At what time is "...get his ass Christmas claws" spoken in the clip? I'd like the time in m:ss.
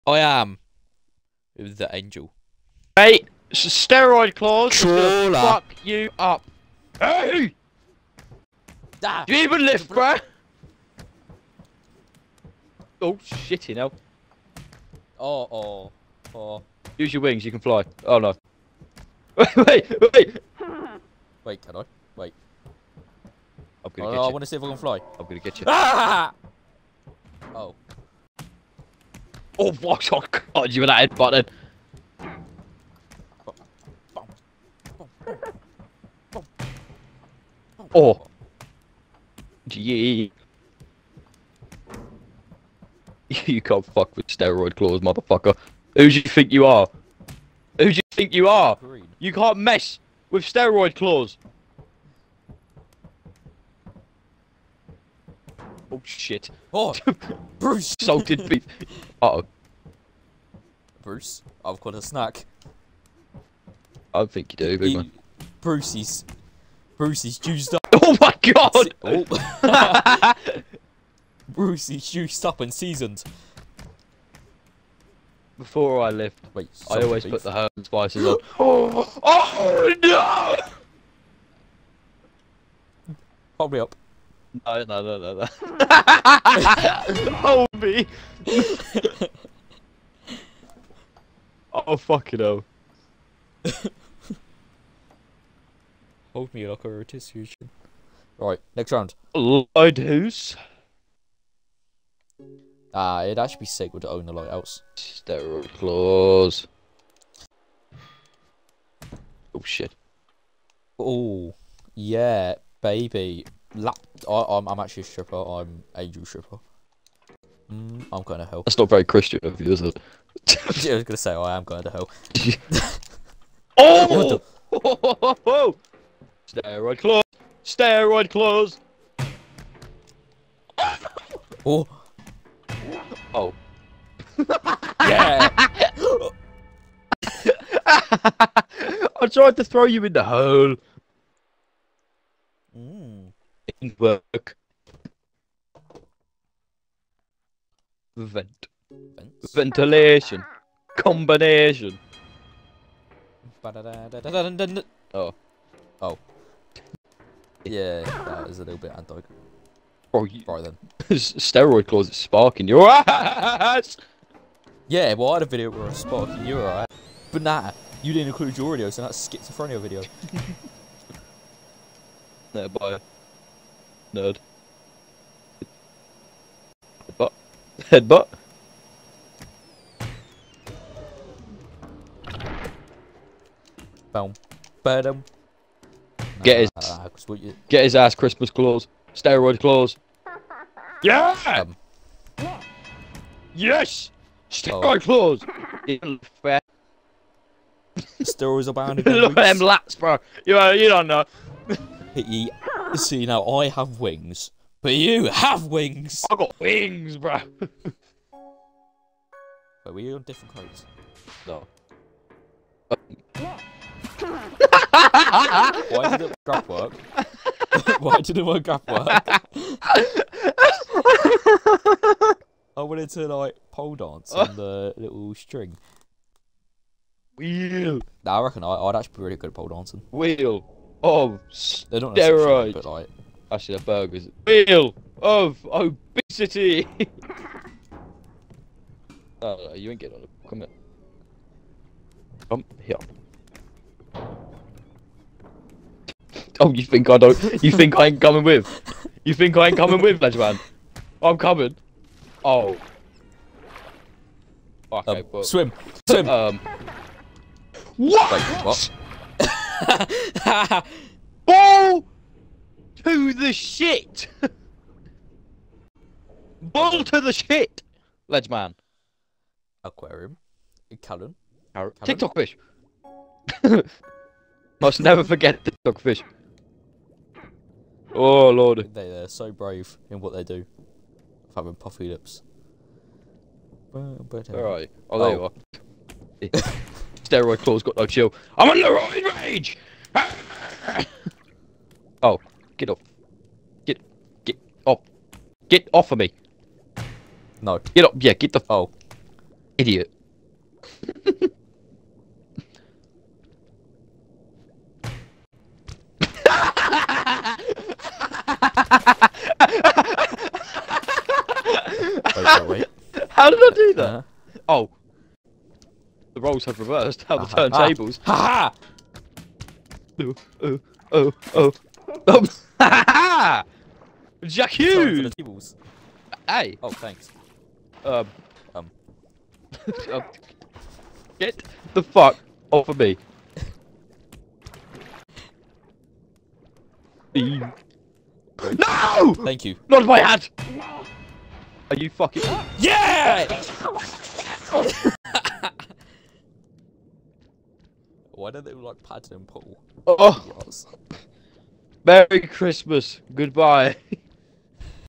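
3:07.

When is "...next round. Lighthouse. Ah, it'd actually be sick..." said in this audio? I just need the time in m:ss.
1:38.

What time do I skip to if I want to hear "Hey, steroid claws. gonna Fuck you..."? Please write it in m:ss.
0:02.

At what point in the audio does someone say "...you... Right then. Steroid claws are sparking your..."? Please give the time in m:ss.
2:40.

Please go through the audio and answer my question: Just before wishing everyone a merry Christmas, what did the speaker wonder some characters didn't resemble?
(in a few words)
Paddington Pool.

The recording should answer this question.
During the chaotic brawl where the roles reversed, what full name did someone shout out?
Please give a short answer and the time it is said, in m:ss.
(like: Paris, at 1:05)
Jack Hughes, at 5:24.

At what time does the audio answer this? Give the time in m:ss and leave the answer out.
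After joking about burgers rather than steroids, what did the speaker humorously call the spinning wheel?
3:54.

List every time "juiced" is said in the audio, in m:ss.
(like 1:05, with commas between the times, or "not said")
1:07, 1:12.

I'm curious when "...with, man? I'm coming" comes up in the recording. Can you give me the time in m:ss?
4:10.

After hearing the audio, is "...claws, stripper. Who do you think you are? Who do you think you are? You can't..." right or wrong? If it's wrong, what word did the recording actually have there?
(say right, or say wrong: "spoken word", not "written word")
wrong: "motherfucker", not "stripper".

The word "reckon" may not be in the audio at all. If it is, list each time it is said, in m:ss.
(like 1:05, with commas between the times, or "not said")
3:48.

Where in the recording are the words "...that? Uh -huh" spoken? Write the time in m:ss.
5:13.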